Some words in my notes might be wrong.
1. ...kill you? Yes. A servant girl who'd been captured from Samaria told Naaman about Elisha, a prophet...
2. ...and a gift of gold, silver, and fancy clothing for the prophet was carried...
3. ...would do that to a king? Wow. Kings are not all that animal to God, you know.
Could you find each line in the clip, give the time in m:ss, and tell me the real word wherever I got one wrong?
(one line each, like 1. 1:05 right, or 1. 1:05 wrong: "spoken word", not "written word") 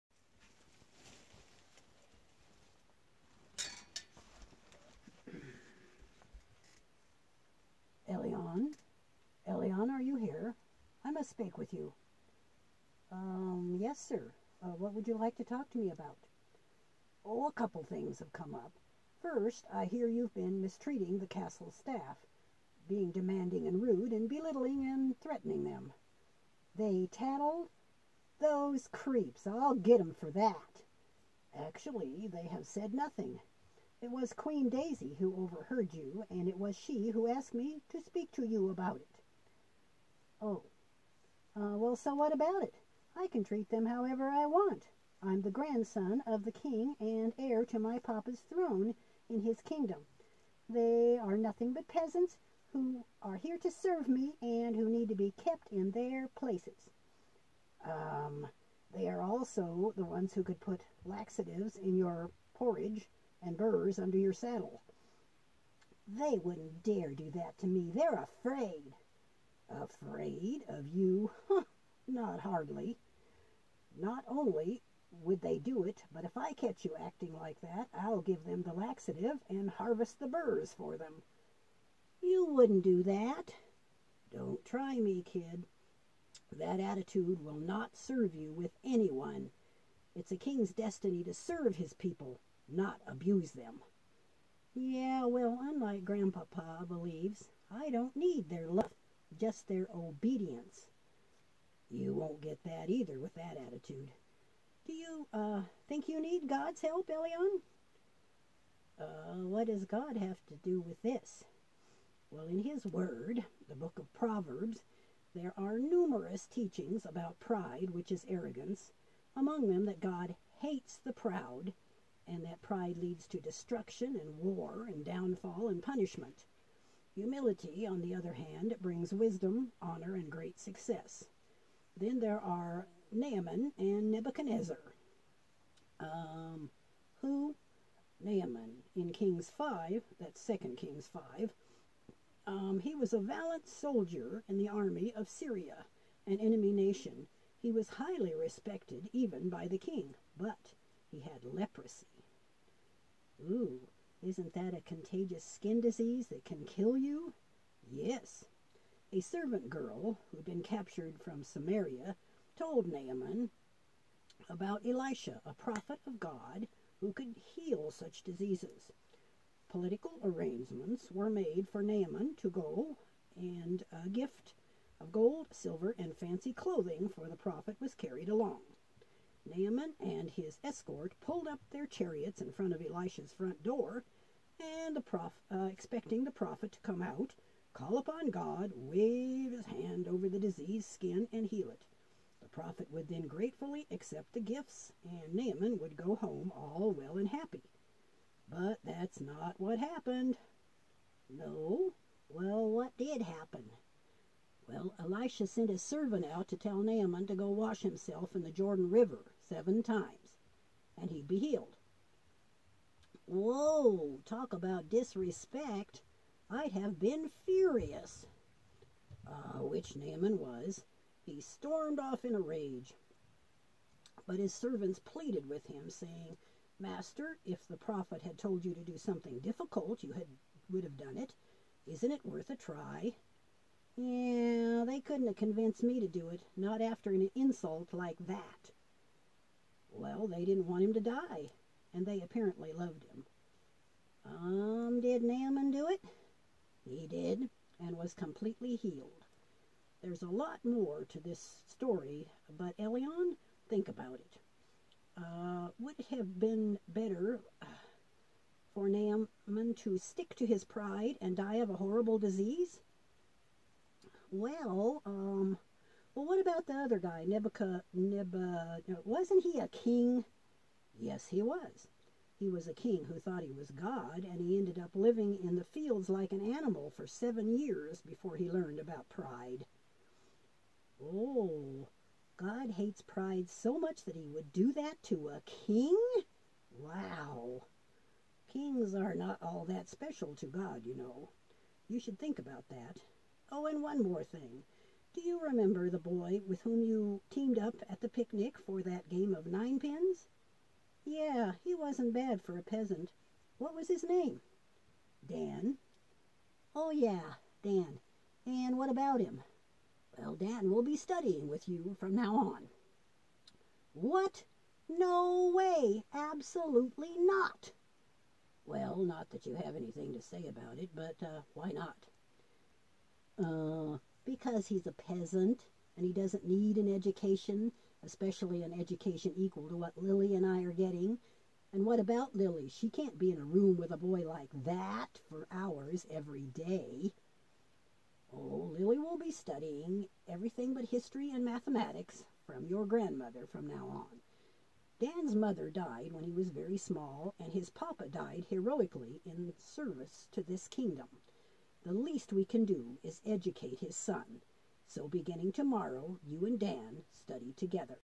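1. 2:36 right
2. 2:53 right
3. 4:44 wrong: "special", not "animal".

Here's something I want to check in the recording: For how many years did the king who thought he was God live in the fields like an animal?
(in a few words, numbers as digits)
7.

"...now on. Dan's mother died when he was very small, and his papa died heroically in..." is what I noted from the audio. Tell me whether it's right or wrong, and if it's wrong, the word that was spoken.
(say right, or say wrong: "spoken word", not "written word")
right.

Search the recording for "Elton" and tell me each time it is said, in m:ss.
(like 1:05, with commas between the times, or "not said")
1:47, 4:12.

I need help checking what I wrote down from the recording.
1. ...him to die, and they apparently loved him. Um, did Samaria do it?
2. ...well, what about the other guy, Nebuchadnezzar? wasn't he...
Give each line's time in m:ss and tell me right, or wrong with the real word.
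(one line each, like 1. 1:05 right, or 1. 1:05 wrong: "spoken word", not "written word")
1. 4:00 wrong: "Naaman", not "Samaria"
2. 4:26 right.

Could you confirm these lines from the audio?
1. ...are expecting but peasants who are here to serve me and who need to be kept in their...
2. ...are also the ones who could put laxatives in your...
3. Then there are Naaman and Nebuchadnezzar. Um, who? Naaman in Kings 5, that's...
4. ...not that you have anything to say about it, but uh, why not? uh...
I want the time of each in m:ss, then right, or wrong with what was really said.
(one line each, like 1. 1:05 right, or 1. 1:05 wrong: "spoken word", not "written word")
1. 0:51 wrong: "nothing", not "expecting"
2. 0:59 right
3. 2:11 right
4. 5:18 right.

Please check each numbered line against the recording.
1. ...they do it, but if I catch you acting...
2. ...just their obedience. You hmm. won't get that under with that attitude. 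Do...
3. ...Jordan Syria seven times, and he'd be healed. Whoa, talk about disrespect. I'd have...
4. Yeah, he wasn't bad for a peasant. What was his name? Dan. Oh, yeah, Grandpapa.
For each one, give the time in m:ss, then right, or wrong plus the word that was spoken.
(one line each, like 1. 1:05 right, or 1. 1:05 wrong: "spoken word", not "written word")
1. 1:15 right
2. 1:39 wrong: "either", not "under"
3. 3:28 wrong: "River", not "Syria"
4. 5:01 wrong: "Dan", not "Grandpapa".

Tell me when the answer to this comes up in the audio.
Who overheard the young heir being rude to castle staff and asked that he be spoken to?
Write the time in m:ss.
0:34.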